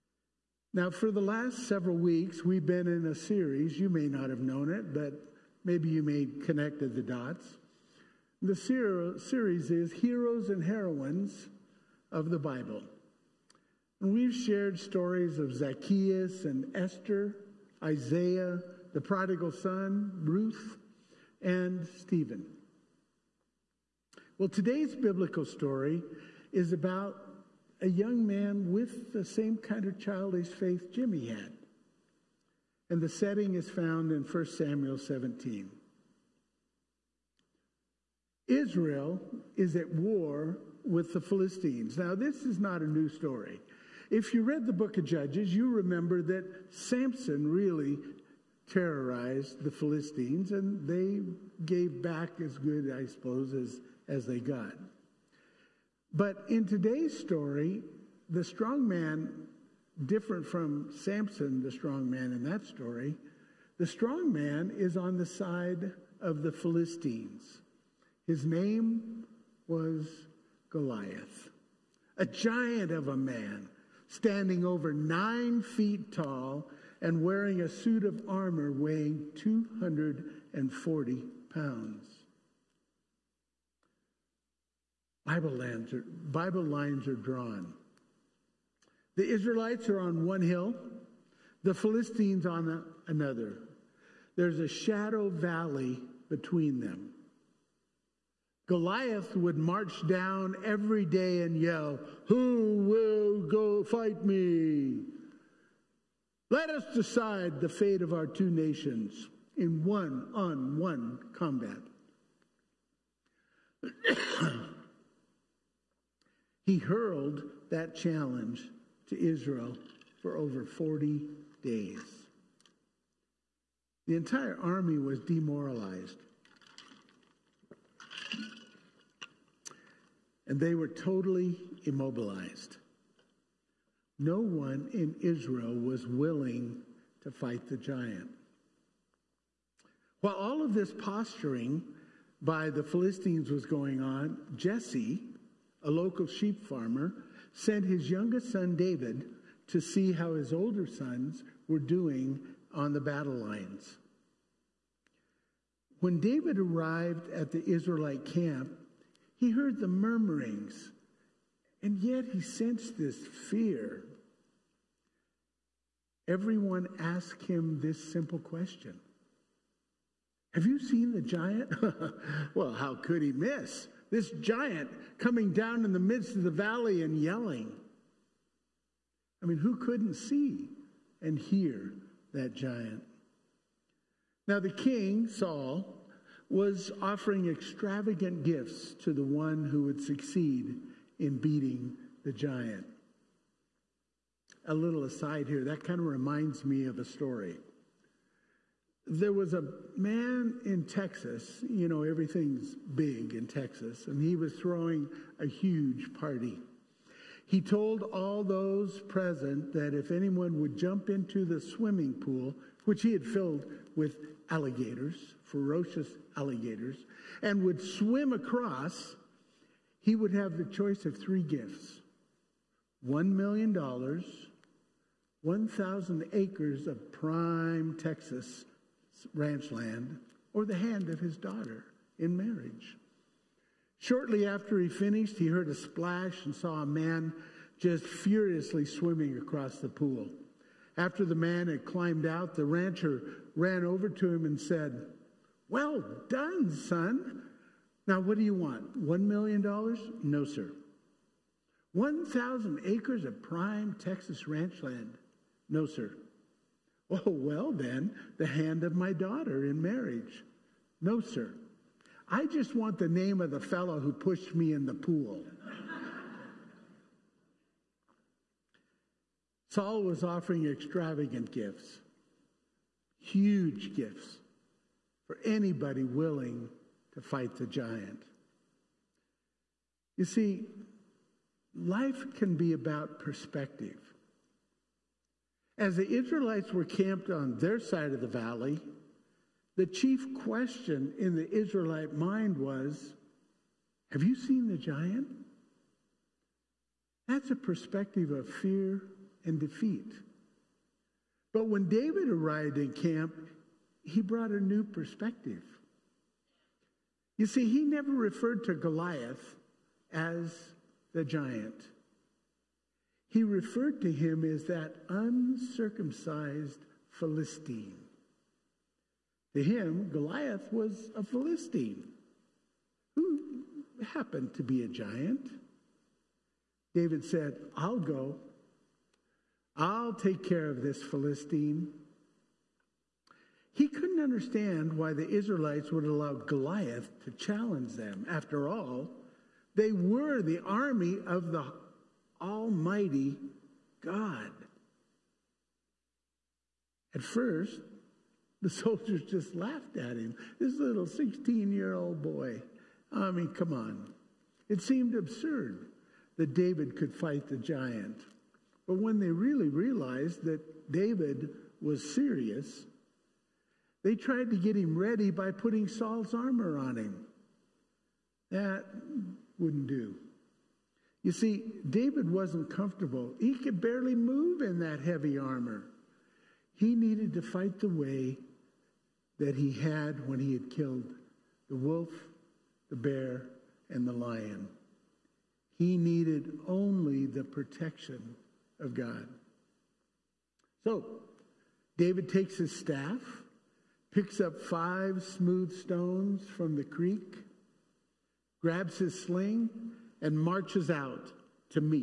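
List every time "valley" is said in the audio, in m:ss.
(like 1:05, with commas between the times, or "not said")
1:35, 2:56, 4:48.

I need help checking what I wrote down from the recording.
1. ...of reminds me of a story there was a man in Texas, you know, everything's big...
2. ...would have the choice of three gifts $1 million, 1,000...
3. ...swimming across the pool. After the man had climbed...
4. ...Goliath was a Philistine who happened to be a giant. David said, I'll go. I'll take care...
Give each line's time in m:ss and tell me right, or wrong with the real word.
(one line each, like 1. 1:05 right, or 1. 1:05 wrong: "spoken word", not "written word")
1. 3:15 right
2. 3:40 right
3. 3:58 right
4. 5:20 right.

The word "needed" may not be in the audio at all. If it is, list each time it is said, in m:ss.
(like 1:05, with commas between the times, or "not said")
6:16, 6:25.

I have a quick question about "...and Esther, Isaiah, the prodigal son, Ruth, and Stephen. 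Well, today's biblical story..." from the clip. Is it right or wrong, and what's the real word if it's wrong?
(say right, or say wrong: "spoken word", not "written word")
right.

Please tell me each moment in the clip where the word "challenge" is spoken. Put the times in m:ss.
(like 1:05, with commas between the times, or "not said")
1:57, 5:37.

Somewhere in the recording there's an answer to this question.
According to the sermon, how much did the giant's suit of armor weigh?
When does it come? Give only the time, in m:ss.
1:19.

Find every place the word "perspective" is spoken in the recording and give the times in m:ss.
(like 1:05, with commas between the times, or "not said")
4:43, 4:57, 5:04.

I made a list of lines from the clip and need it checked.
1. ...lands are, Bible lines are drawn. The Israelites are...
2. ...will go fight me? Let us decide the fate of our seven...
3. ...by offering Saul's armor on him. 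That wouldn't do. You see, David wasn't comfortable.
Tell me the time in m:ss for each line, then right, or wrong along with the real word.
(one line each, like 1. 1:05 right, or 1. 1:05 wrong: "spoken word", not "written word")
1. 1:25 right
2. 1:42 wrong: "two", not "seven"
3. 6:05 wrong: "putting", not "offering".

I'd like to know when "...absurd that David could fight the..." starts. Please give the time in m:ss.
5:55.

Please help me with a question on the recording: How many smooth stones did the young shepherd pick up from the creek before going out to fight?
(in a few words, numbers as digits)
5.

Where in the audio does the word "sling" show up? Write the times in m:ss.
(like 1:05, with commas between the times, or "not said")
6:39.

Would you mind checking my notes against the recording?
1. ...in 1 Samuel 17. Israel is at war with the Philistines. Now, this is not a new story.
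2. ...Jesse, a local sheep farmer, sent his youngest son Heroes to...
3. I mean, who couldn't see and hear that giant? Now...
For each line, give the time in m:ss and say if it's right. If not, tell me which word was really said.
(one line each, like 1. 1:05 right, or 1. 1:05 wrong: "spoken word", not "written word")
1. 0:34 right
2. 2:24 wrong: "David", not "Heroes"
3. 2:59 right.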